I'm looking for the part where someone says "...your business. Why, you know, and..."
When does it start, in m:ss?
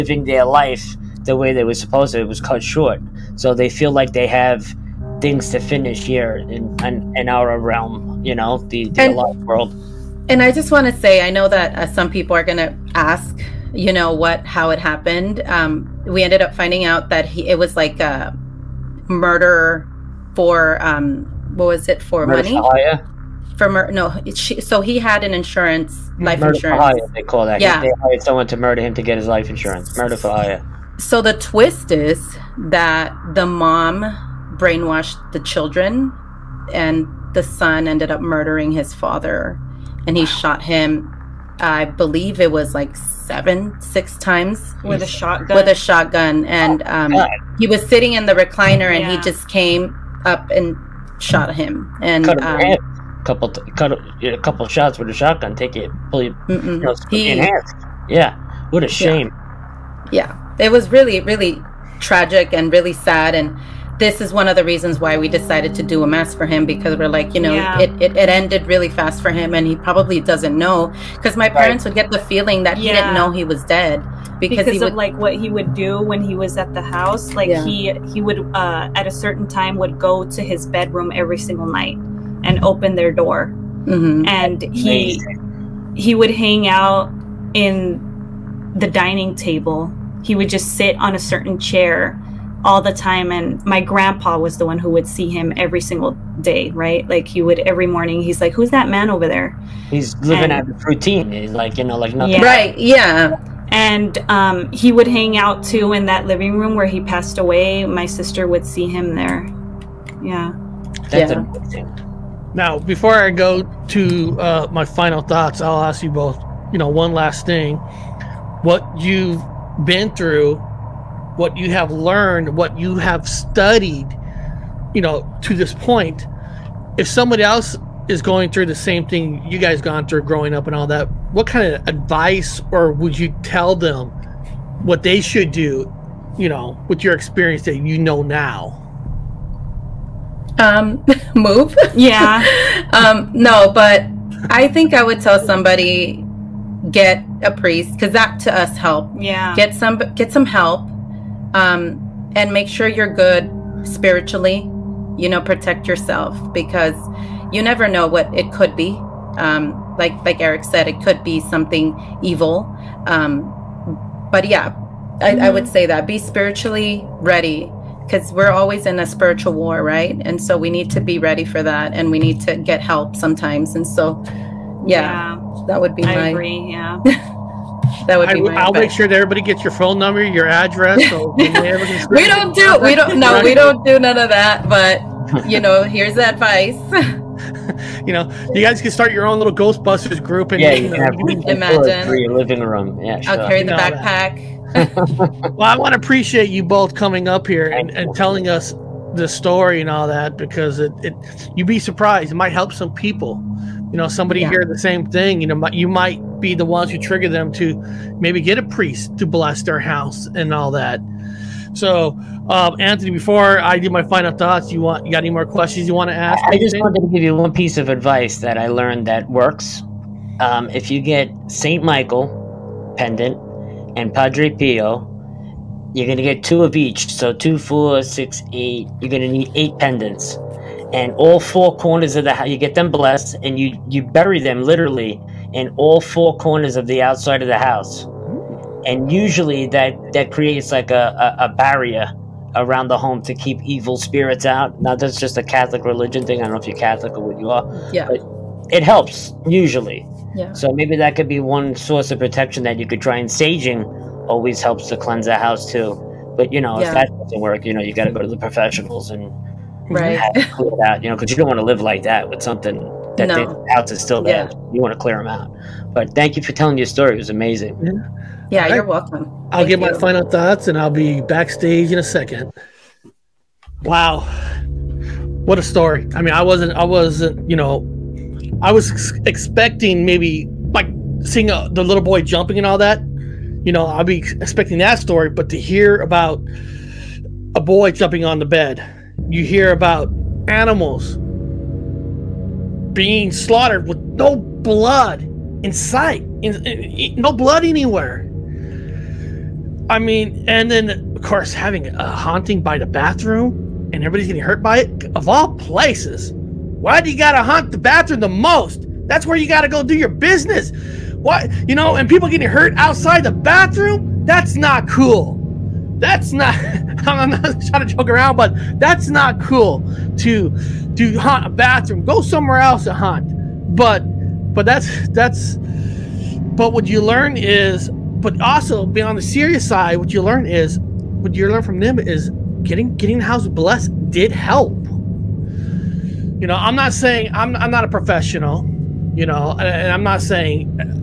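5:09.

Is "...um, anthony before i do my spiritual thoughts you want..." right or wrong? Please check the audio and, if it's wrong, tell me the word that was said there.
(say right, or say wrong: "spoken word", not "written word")
wrong: "final", not "spiritual".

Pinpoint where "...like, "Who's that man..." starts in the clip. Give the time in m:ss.
1:38.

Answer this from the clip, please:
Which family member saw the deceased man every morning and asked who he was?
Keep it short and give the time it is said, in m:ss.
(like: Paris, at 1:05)
Grandpa, at 1:33.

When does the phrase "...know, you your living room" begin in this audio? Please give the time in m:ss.
3:10.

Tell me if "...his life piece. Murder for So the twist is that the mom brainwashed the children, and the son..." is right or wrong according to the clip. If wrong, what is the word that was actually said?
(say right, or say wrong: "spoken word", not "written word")
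wrong: "insurance", not "piece".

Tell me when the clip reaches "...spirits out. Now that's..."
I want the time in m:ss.
4:03.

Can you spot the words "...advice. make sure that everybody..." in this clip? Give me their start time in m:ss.
2:58.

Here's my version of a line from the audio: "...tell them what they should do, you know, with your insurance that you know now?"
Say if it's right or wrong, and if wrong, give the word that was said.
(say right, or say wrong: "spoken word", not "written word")
wrong: "experience", not "insurance".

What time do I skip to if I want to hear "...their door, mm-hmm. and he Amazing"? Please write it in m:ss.
1:22.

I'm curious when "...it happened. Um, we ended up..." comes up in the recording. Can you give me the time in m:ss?
0:14.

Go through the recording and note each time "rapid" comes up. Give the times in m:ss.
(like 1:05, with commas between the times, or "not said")
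not said.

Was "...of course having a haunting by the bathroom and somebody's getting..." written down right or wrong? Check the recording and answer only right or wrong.
wrong.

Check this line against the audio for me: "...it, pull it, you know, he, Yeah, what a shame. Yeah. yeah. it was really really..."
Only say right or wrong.
right.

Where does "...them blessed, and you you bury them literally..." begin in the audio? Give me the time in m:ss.
3:52.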